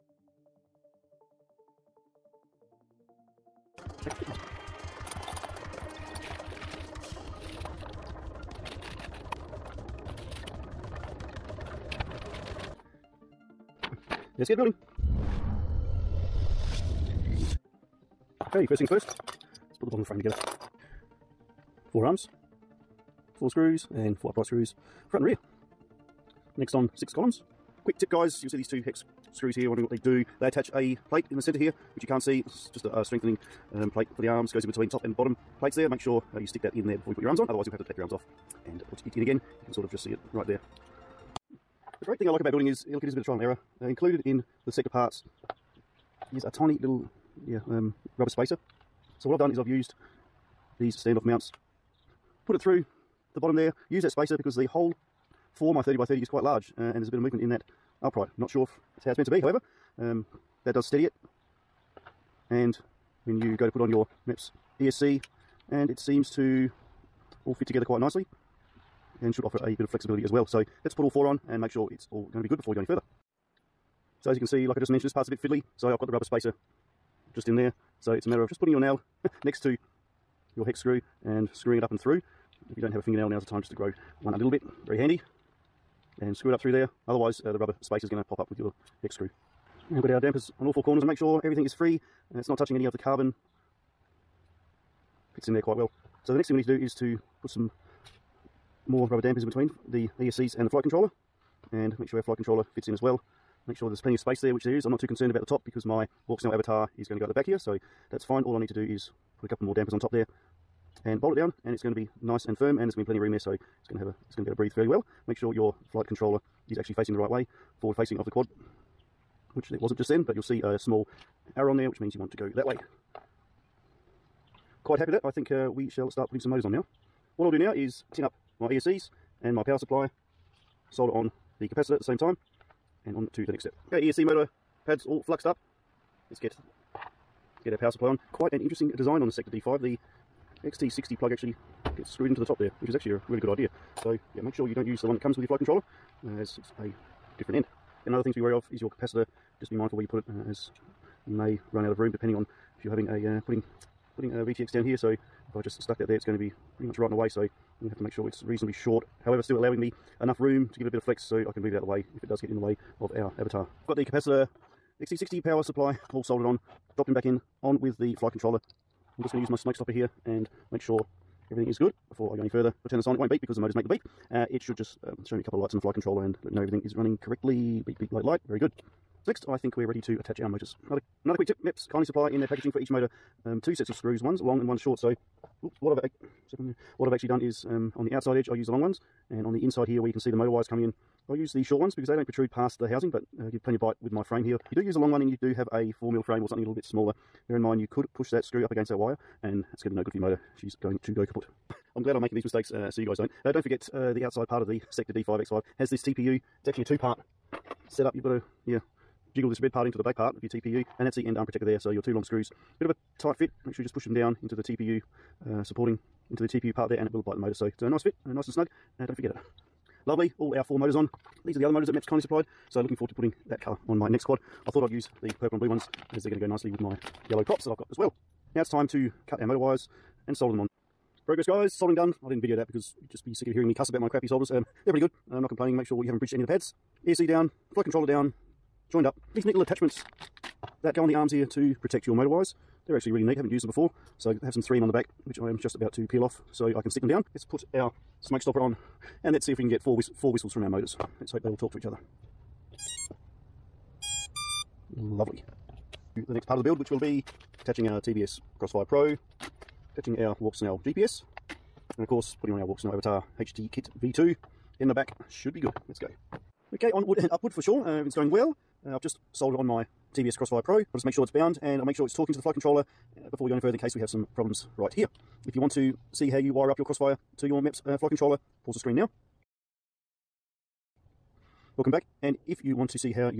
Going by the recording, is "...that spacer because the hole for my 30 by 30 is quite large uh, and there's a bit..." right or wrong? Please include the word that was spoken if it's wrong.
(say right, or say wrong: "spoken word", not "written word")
right.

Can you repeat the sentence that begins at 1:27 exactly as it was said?
Otherwise, uh, the rubber space is going to pop up with your hex screw.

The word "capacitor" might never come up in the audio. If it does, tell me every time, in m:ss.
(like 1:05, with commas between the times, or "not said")
2:11, 2:28, 2:44.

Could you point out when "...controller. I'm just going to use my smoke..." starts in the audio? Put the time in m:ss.
2:48.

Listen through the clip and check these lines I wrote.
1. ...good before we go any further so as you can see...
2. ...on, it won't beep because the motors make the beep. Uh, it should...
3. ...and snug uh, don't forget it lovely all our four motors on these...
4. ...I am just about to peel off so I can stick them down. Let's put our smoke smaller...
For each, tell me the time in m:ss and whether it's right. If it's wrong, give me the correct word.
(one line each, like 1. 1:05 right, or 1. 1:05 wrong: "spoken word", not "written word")
1. 1:12 right
2. 2:53 right
3. 3:38 right
4. 4:05 wrong: "stopper", not "smaller".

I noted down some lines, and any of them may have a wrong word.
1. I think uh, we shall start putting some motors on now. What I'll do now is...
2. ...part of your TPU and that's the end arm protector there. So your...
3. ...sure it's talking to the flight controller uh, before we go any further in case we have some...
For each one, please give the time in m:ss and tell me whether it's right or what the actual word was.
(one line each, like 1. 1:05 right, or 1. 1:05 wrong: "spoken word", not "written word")
1. 2:05 right
2. 3:30 right
3. 4:31 right.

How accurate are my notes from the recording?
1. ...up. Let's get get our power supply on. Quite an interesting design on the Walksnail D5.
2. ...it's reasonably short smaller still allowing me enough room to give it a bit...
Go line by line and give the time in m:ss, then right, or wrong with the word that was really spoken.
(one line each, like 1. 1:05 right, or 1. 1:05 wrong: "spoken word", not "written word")
1. 2:15 wrong: "Sector", not "Walksnail"
2. 2:38 wrong: "however", not "smaller".